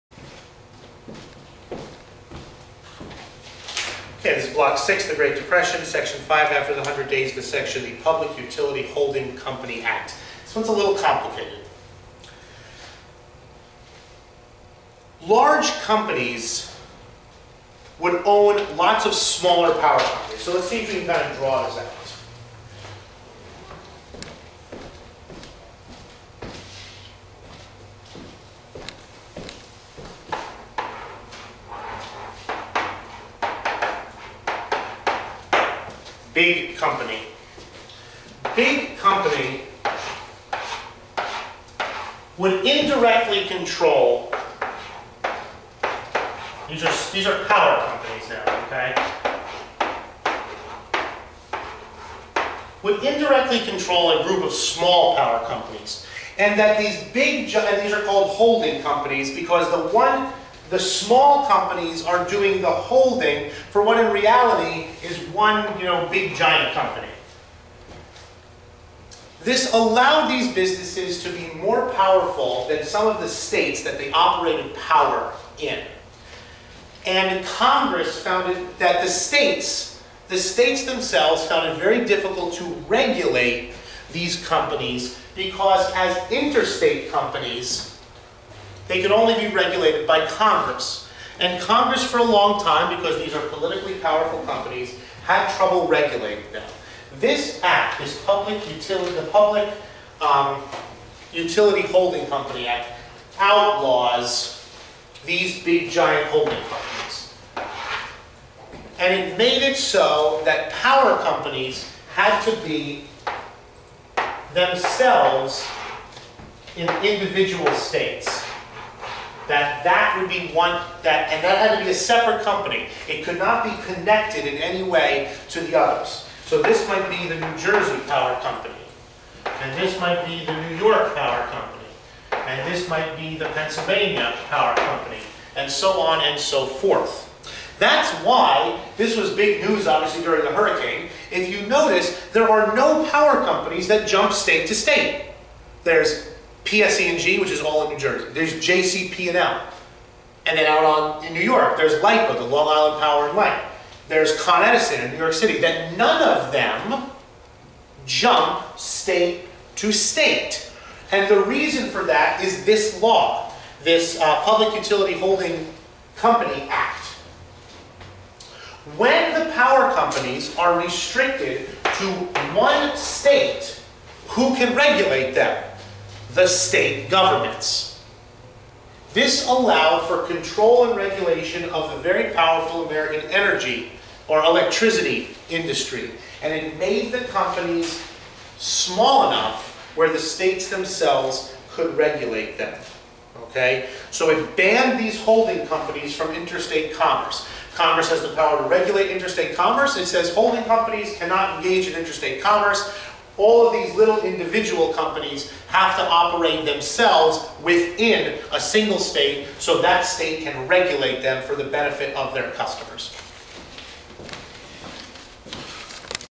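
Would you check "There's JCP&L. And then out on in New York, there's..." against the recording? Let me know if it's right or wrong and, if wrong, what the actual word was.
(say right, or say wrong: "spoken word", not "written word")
right.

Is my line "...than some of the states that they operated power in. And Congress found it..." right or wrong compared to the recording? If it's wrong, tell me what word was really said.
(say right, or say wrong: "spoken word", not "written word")
right.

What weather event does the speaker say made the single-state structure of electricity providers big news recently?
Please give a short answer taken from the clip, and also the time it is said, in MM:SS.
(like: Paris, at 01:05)
the hurricane, at 02:20.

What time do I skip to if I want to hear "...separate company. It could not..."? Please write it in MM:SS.
02:01.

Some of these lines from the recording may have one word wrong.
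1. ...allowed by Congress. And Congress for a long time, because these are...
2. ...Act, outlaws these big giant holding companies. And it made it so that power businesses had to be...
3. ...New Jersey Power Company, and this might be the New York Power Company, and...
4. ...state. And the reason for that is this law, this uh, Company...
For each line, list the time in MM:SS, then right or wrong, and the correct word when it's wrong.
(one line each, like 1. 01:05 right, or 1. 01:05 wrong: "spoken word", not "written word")
1. 01:29 wrong: "regulated", not "allowed"
2. 01:42 wrong: "companies", not "businesses"
3. 02:07 right
4. 02:39 wrong: "Public", not "Company".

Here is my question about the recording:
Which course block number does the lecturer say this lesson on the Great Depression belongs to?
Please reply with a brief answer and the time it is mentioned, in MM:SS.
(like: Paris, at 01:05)
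Block 6, at 00:04.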